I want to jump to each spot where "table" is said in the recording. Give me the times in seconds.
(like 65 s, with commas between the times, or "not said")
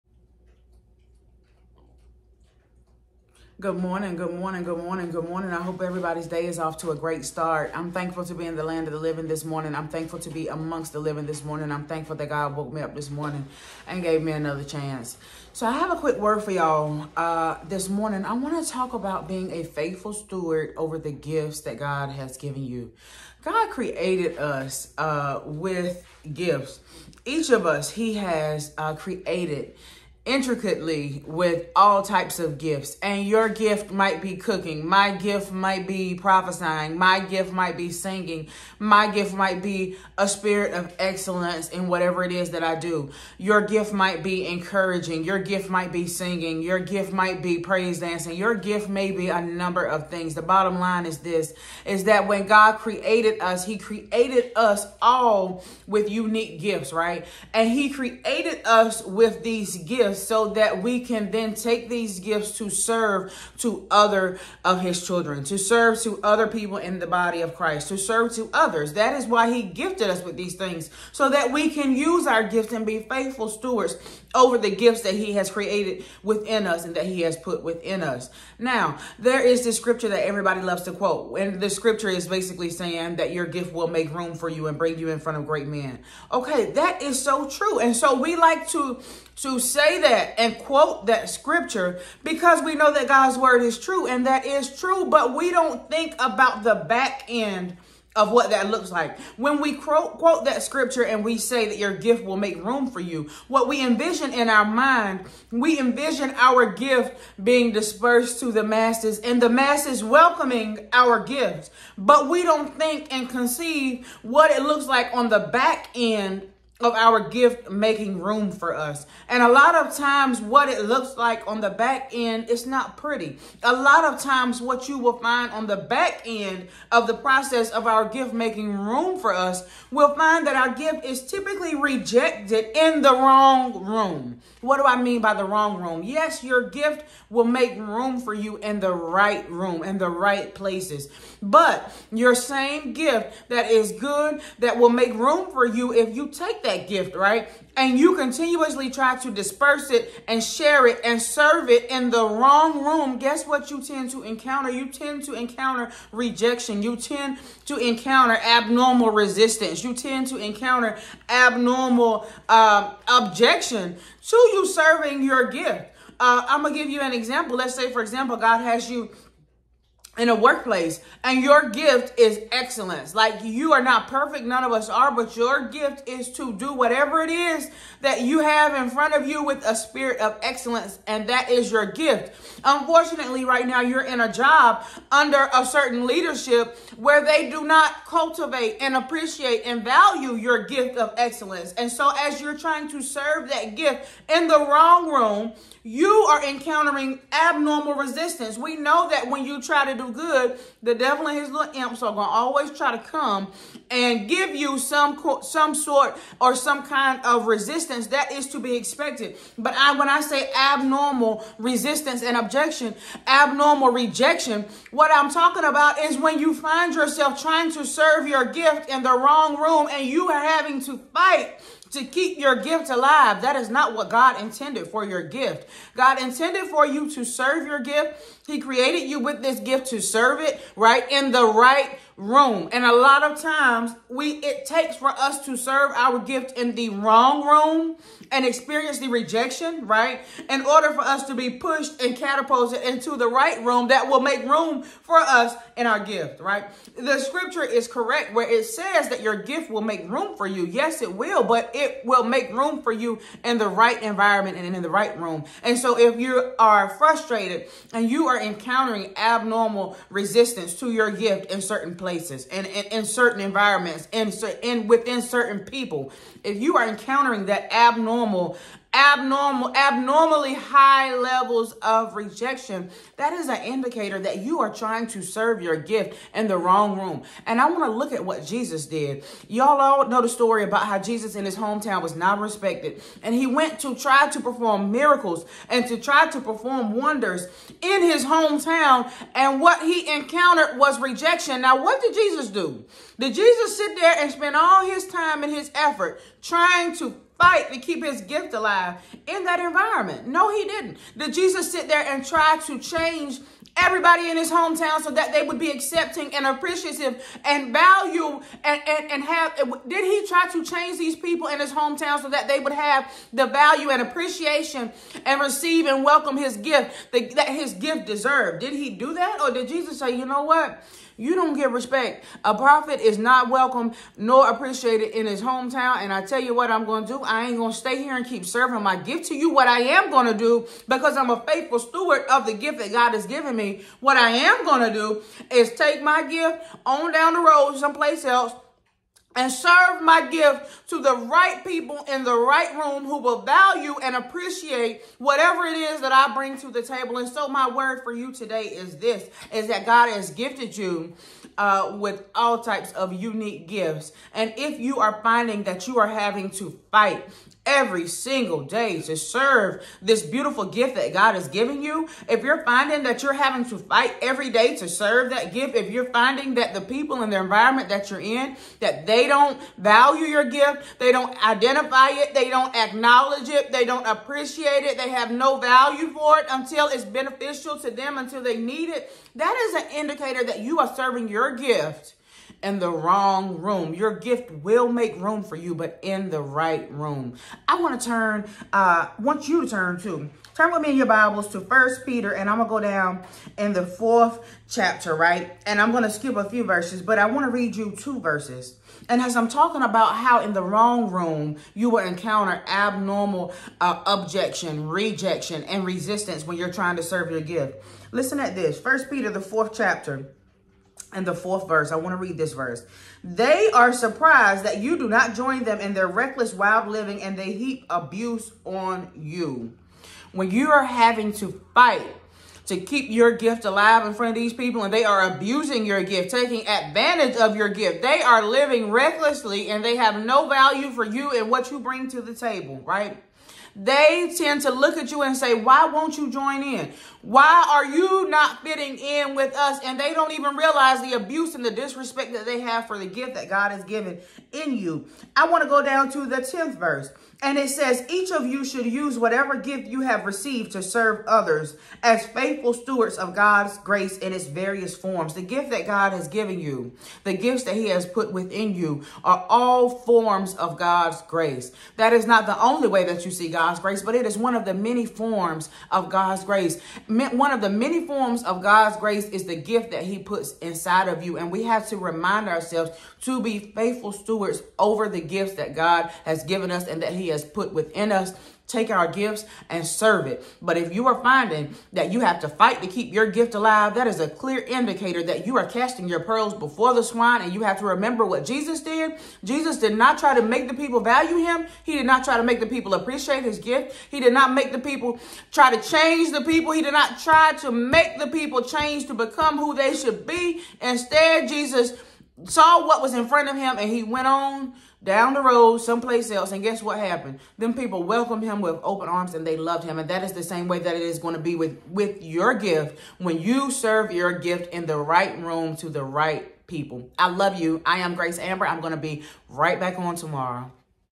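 346 s, 432 s.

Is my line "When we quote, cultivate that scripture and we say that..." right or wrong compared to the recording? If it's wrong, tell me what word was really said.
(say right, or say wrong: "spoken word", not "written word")
wrong: "quote", not "cultivate".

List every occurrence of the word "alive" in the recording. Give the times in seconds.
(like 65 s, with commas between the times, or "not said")
222 s, 298 s, 423 s, 483 s.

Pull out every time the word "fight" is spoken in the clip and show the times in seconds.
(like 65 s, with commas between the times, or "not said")
221 s, 297 s, 356 s, 363 s, 421 s, 482 s.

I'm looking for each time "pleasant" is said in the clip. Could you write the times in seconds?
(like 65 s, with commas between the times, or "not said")
not said.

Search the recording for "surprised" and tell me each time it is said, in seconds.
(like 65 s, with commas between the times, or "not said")
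413 s.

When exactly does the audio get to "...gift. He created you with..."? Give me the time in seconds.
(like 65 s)
227 s.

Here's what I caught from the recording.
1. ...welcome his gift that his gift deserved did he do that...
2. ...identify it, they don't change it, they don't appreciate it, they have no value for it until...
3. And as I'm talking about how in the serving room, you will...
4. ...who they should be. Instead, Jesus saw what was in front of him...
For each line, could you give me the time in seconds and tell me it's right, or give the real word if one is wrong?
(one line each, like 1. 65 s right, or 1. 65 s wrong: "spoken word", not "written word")
1. 316 s right
2. 371 s wrong: "acknowledge", not "change"
3. 399 s wrong: "wrong", not "serving"
4. 499 s right.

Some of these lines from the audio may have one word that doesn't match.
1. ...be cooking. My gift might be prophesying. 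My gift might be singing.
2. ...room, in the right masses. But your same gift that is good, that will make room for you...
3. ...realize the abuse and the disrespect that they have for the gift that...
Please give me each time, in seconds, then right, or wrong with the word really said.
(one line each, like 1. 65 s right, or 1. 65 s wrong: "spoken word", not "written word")
1. 34 s right
2. 139 s wrong: "places", not "masses"
3. 440 s right.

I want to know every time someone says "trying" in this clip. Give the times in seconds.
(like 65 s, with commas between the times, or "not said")
192 s, 217 s, 274 s, 296 s, 406 s.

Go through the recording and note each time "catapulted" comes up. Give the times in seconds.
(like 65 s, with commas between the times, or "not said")
242 s.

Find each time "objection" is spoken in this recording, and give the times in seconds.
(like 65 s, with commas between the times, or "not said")
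163 s, 212 s, 404 s.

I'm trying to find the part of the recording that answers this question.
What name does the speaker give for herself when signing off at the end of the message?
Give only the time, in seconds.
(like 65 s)
517 s.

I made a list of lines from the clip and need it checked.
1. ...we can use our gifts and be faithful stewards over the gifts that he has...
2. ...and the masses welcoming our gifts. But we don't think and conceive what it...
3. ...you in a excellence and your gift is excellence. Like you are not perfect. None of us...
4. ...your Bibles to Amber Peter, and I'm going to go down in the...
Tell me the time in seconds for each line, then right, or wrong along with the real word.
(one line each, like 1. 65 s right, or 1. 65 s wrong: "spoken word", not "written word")
1. 71 s right
2. 109 s right
3. 168 s wrong: "workplace", not "excellence"
4. 390 s wrong: "First", not "Amber".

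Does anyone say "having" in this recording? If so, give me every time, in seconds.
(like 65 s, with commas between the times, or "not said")
220 s, 356 s, 363 s, 420 s.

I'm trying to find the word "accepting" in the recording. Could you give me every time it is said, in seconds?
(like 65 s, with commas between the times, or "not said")
305 s.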